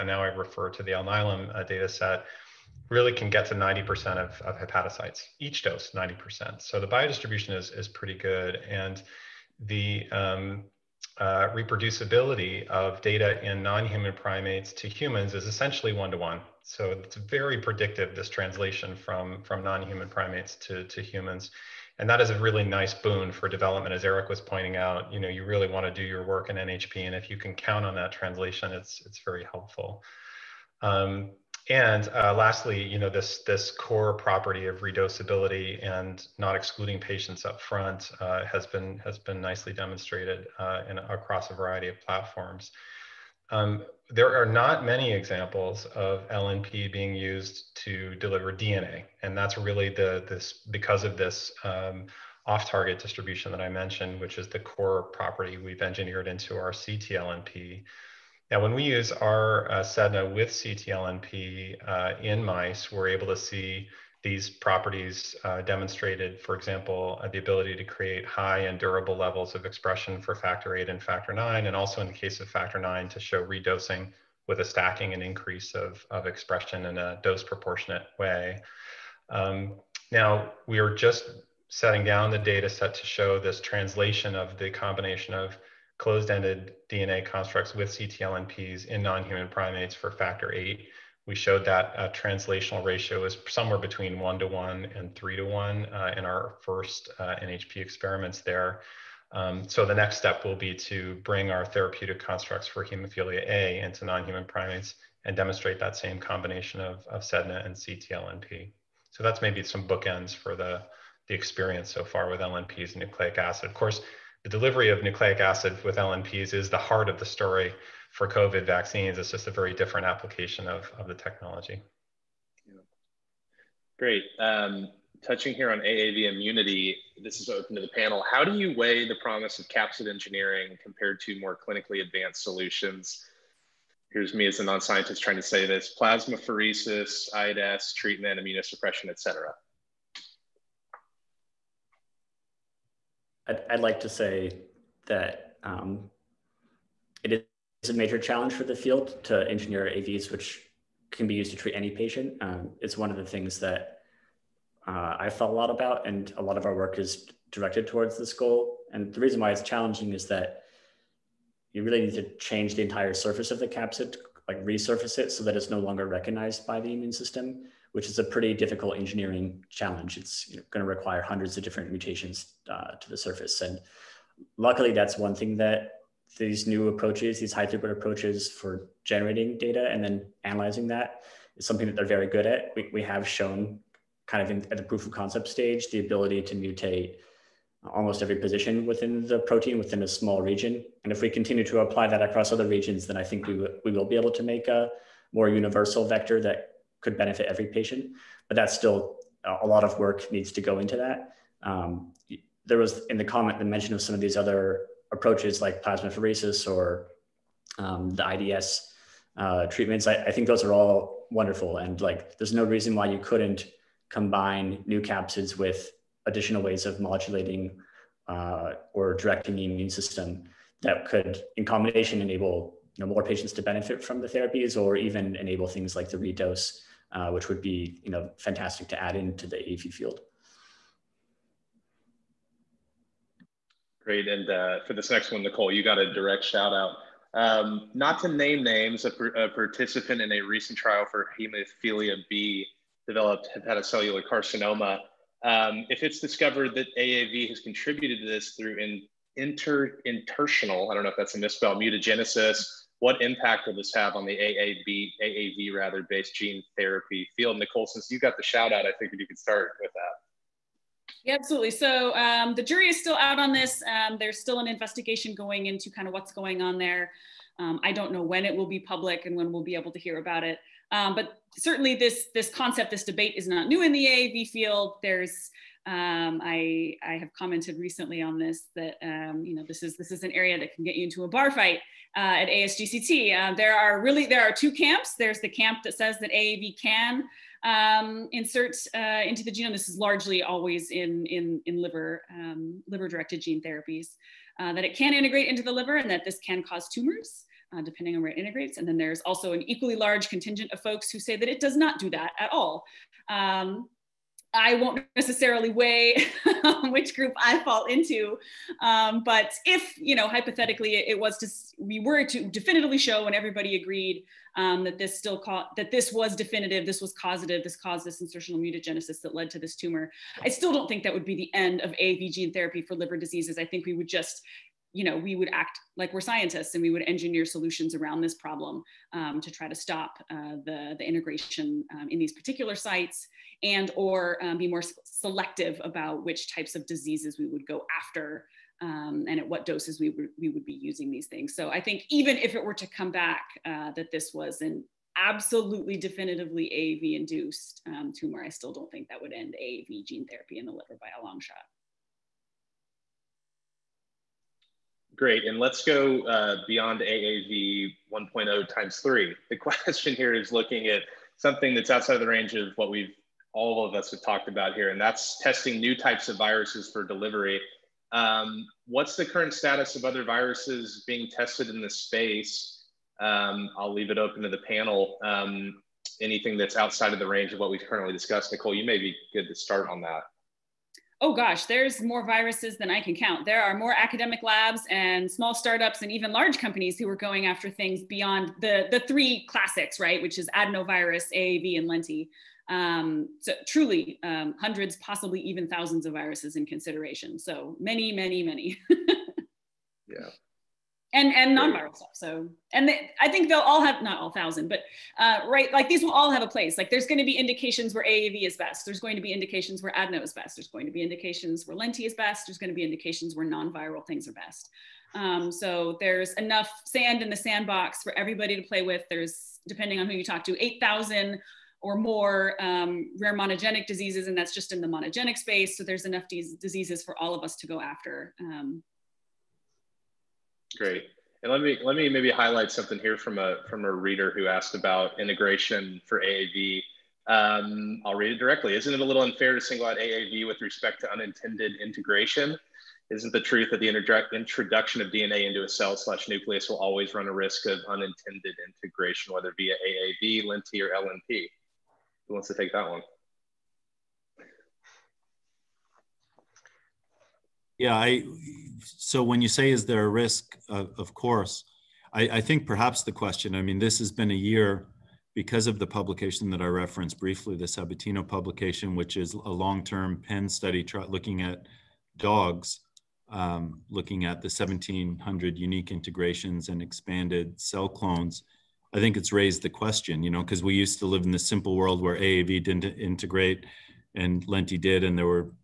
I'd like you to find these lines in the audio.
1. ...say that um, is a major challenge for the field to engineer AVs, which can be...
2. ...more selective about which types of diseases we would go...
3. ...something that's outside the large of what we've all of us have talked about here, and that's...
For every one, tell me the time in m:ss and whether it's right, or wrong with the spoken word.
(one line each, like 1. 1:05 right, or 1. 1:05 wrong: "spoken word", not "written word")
1. 2:24 right
2. 5:34 right
3. 6:01 wrong: "range", not "large".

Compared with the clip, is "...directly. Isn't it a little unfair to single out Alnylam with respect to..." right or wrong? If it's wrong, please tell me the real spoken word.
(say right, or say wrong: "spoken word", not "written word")
wrong: "AAV", not "Alnylam".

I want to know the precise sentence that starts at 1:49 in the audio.
So that's maybe some bookends for the, the experience so far with LNPs and nucleic acid.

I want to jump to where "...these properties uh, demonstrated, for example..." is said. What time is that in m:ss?
1:04.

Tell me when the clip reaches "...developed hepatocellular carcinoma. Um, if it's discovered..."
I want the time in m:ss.
4:03.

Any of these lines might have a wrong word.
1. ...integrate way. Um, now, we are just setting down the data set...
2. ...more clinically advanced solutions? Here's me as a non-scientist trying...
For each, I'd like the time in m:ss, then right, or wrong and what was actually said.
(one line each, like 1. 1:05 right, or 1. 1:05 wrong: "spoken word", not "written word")
1. 1:17 wrong: "proportionate", not "integrate"
2. 2:11 right.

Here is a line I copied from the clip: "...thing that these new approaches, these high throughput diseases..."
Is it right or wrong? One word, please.
wrong.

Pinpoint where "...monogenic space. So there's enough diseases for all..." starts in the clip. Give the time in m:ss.
7:04.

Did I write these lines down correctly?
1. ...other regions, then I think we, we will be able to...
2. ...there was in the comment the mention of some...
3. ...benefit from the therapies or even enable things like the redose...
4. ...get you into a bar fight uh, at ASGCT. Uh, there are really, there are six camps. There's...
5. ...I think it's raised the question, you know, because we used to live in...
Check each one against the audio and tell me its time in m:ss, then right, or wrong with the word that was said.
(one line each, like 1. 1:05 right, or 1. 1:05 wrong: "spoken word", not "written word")
1. 3:12 right
2. 3:22 right
3. 3:43 right
4. 4:40 wrong: "two", not "six"
5. 7:58 right.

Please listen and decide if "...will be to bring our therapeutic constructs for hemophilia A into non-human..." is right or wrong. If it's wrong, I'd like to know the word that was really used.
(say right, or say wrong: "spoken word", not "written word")
right.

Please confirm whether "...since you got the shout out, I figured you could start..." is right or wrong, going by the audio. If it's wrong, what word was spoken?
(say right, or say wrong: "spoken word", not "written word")
right.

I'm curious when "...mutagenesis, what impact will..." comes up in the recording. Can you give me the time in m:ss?
4:11.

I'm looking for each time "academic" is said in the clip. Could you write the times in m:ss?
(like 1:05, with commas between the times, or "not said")
6:23.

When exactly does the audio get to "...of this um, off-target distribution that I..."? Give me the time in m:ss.
0:51.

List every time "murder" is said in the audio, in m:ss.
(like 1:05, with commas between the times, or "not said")
not said.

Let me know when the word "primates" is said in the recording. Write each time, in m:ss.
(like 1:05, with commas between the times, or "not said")
0:14, 0:20, 1:29, 1:44.